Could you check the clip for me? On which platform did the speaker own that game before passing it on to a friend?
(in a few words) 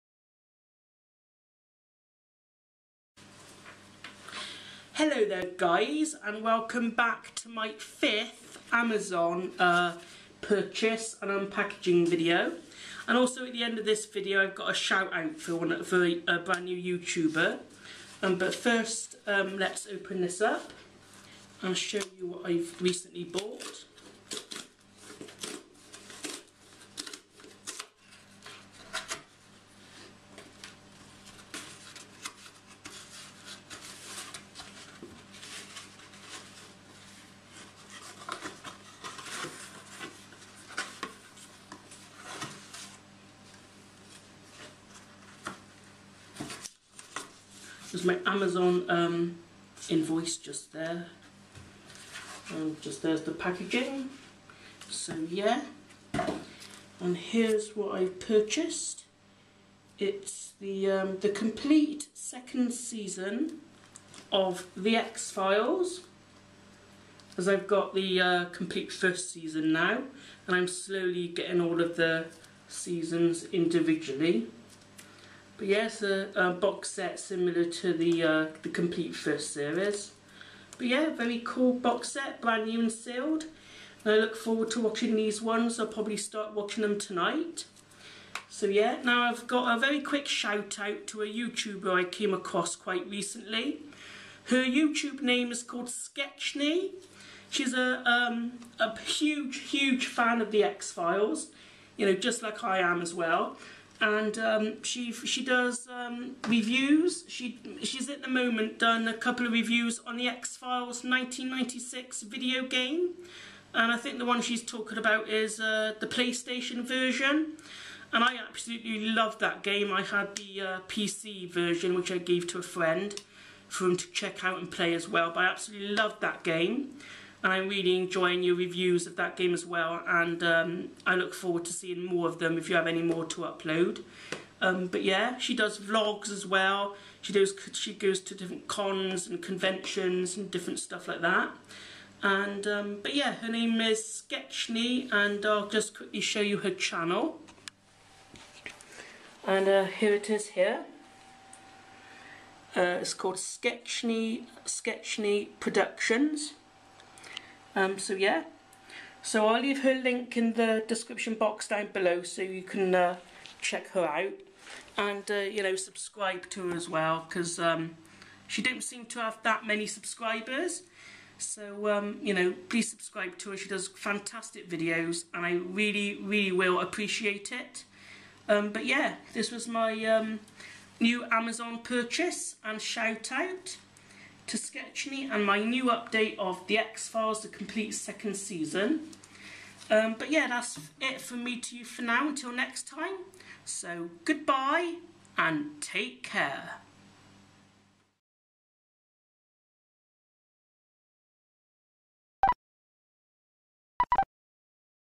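PC.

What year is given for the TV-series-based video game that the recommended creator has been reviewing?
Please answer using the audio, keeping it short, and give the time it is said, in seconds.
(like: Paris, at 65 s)
1996, at 111 s.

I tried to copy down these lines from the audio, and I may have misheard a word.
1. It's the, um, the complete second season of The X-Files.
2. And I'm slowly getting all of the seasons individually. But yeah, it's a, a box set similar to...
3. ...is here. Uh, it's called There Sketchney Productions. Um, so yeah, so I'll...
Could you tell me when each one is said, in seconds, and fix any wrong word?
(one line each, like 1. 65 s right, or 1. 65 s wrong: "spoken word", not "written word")
1. 59 s right
2. 70 s right
3. 150 s wrong: "Sketchney", not "There".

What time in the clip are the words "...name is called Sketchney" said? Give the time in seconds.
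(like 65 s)
95 s.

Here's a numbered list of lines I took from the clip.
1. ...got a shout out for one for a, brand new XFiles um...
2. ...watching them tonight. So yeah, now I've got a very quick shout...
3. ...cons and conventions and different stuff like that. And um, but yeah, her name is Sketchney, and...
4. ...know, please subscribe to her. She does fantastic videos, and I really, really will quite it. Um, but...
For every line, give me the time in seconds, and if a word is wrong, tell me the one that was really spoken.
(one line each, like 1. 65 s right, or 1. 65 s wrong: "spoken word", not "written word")
1. 14 s wrong: "YouTuber", not "XFiles"
2. 86 s right
3. 138 s right
4. 172 s wrong: "appreciate", not "quite".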